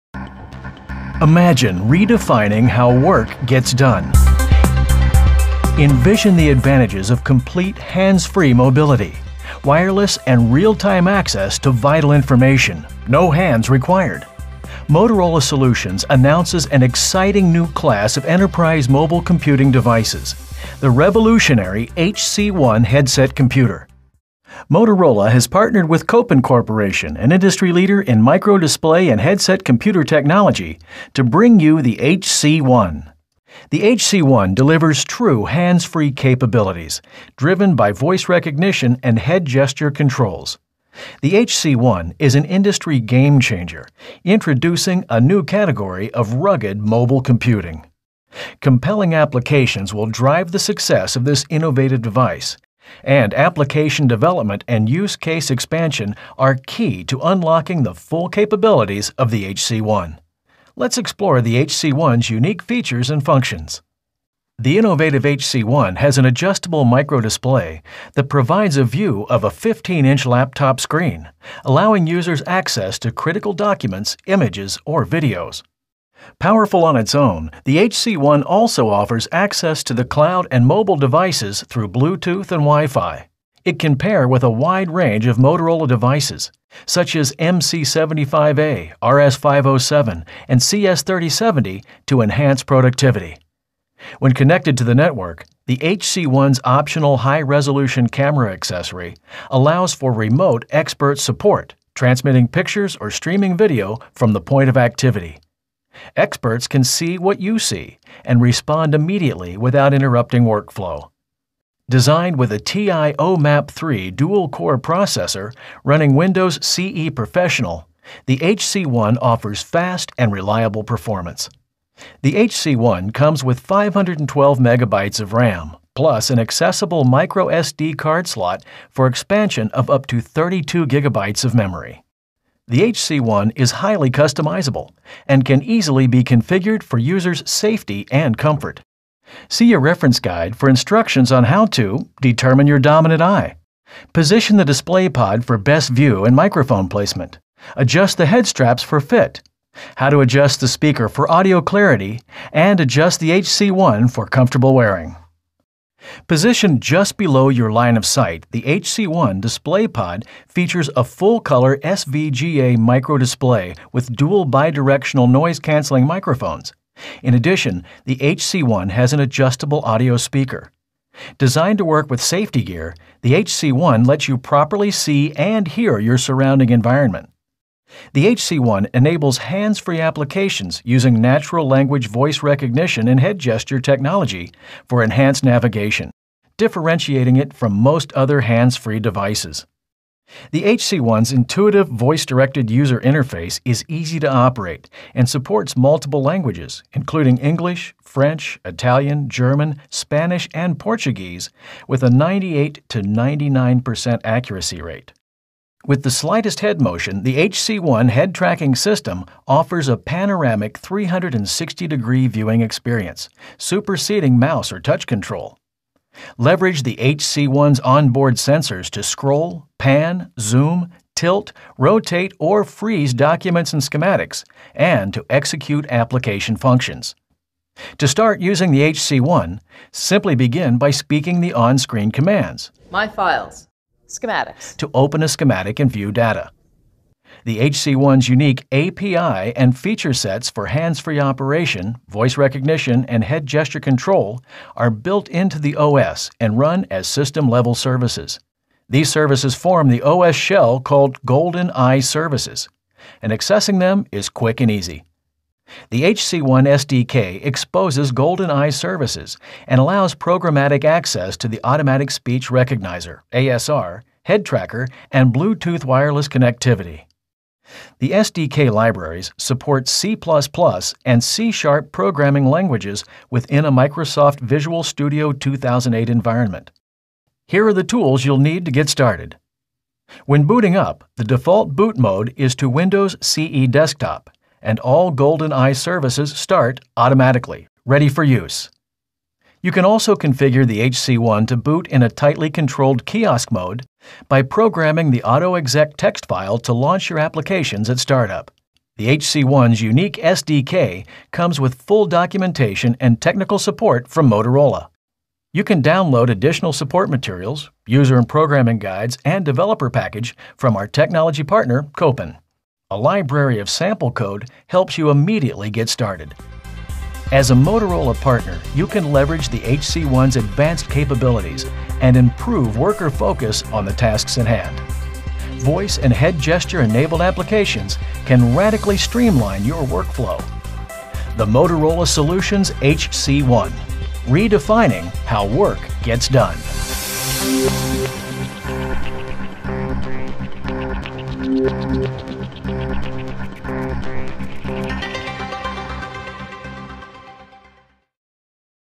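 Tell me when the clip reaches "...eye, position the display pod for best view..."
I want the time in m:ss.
2:23.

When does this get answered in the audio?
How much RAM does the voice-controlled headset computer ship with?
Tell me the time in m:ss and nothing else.
2:03.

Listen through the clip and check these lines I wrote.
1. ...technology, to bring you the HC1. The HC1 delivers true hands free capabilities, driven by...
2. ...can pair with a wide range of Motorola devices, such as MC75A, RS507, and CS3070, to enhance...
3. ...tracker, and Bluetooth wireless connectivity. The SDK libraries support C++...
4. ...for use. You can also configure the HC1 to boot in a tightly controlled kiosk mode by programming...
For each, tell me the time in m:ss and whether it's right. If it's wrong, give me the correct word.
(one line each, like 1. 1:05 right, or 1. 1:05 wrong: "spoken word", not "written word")
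1. 0:30 right
2. 1:23 right
3. 4:24 right
4. 4:48 right.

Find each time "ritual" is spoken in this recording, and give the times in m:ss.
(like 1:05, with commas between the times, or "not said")
not said.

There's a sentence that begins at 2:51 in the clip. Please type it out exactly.
Designed to work with safety gear, the HC1 lets you properly see and hear your surrounding environment.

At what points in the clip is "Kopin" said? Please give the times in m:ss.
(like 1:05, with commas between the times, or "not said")
0:26, 5:11.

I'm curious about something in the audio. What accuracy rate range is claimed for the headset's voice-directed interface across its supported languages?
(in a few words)
98 to 99%.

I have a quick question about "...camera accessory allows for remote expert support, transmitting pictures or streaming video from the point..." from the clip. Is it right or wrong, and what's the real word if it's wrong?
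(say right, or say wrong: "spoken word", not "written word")
right.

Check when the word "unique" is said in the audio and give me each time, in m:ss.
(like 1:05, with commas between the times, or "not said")
1:02, 3:58, 4:59.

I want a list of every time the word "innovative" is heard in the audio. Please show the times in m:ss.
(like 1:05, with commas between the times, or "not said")
0:51, 1:04.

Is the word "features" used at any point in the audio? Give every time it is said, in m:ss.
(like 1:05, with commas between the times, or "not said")
1:02, 2:40, 3:59.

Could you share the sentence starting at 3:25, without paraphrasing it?
With the slightest head motion, the HC1 head tracking system offers a panoramic 360 degree viewing experience, superseding mouse or touch control.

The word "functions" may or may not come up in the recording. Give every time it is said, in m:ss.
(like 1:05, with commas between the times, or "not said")
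1:03, 3:46.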